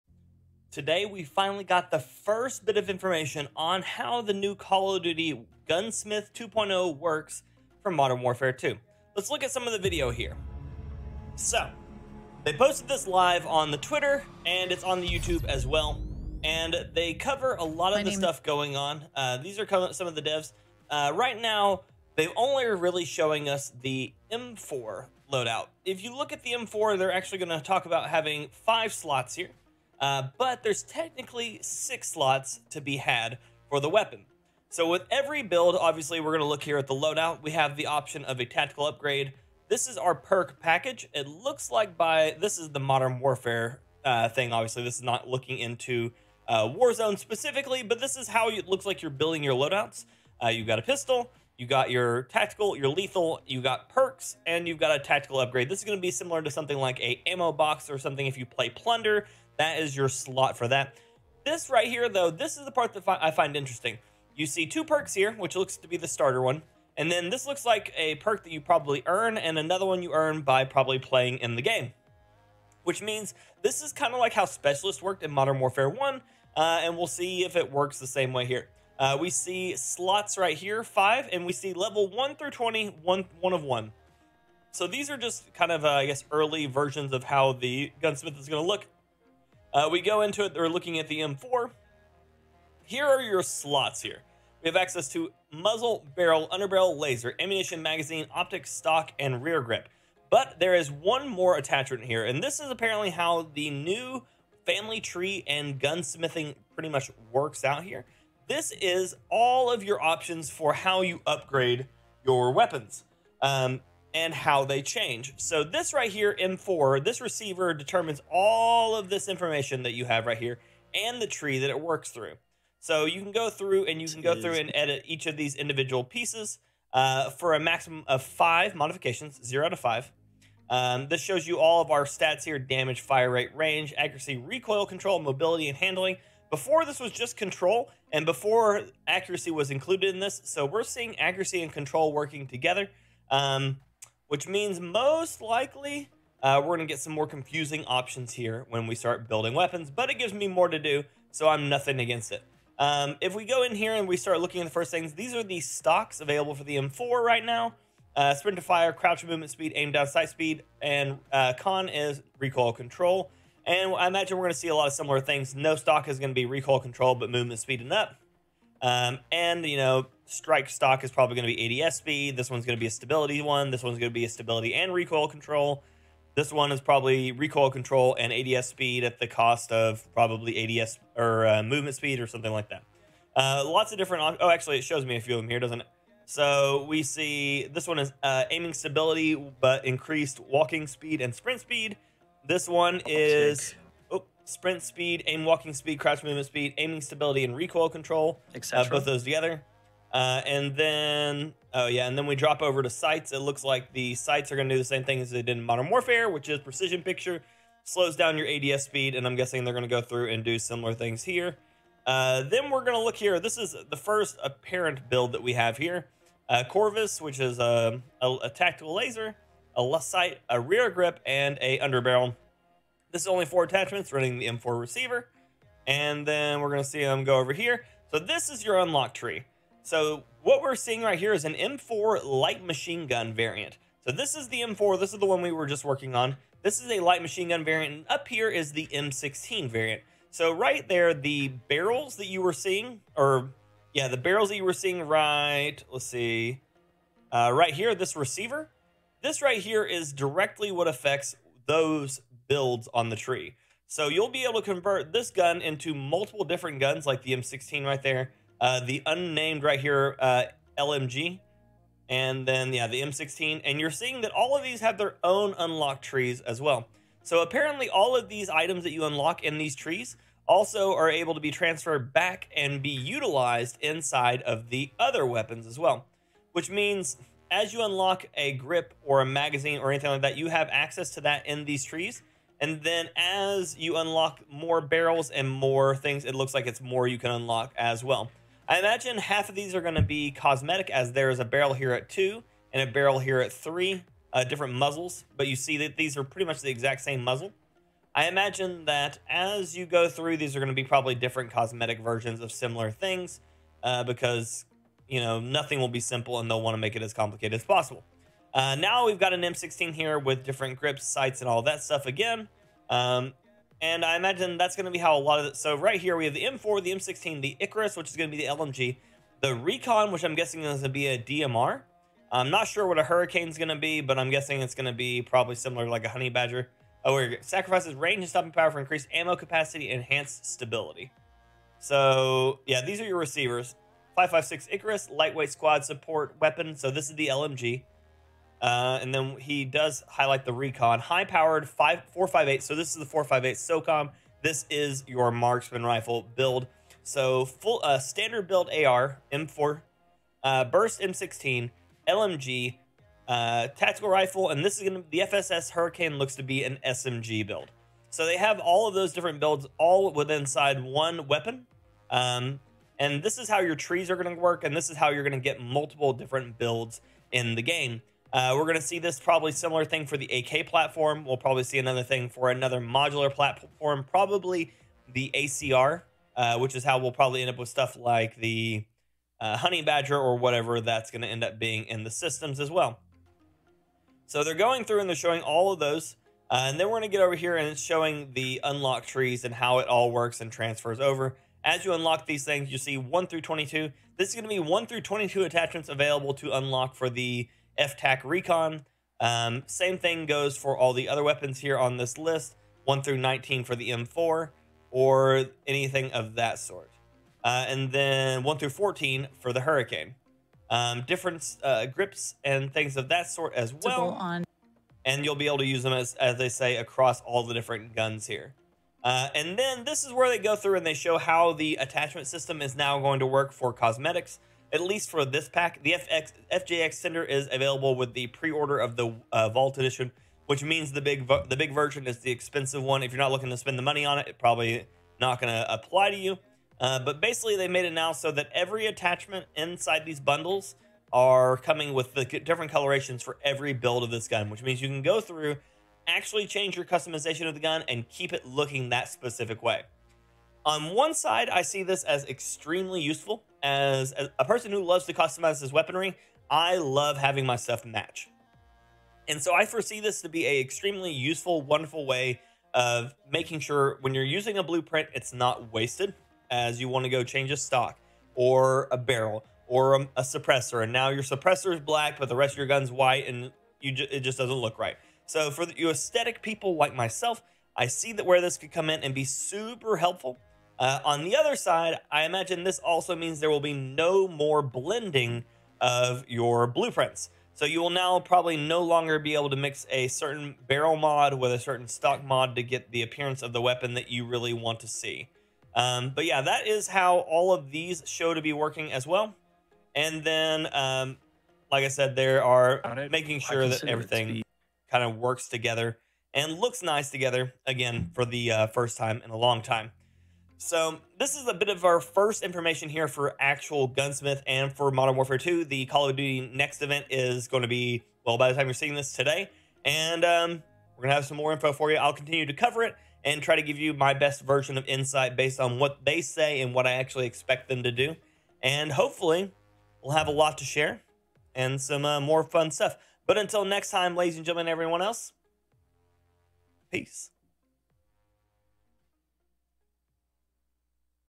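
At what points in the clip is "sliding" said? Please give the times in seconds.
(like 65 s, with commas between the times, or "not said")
not said.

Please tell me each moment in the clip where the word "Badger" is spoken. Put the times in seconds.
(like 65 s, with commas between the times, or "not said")
326 s, 379 s.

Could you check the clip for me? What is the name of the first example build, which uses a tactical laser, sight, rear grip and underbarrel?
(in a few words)
Corvus.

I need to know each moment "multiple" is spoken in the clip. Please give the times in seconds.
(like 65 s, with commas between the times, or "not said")
255 s, 365 s.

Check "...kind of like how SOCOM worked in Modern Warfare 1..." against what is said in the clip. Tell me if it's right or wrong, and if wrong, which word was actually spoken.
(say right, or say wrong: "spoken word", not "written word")
wrong: "Specialist", not "SOCOM".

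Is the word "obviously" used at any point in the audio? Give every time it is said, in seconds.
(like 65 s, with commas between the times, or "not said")
35 s, 44 s.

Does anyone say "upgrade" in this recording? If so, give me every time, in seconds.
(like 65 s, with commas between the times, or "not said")
38 s, 55 s, 111 s.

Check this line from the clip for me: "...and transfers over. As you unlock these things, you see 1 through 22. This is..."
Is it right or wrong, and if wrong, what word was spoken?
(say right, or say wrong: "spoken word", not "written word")
right.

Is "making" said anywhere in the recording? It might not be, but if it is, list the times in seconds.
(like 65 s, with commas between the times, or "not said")
463 s, 503 s.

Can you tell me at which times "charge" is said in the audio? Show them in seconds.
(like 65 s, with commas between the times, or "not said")
not said.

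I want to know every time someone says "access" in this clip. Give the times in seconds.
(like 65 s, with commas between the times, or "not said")
94 s, 280 s.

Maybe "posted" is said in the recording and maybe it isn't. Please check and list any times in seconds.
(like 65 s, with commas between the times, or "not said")
12 s.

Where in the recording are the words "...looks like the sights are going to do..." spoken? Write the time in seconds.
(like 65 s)
203 s.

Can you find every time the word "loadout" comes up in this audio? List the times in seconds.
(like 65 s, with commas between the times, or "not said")
25 s, 36 s, 49 s.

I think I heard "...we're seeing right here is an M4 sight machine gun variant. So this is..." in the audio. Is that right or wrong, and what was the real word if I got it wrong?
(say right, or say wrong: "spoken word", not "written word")
wrong: "light", not "sight".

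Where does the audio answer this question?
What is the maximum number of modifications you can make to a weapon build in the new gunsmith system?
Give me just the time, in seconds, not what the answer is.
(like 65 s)
127 s.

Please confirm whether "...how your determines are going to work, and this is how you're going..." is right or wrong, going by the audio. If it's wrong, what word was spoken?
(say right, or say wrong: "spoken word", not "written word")
wrong: "trees", not "determines".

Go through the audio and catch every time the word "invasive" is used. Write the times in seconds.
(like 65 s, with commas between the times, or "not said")
not said.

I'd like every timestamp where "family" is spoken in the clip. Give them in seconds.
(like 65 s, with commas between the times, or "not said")
104 s.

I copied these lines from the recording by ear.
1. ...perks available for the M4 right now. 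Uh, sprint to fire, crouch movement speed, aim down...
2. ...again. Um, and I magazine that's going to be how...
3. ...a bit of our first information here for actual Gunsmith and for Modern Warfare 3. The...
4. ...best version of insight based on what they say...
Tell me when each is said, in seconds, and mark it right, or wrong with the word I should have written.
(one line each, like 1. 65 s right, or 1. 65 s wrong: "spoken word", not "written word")
1. 155 s wrong: "stocks", not "perks"
2. 312 s wrong: "imagine", not "magazine"
3. 511 s wrong: "2", not "3"
4. 524 s right.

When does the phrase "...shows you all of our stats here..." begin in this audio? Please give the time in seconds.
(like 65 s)
131 s.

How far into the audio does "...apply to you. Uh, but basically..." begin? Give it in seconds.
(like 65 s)
435 s.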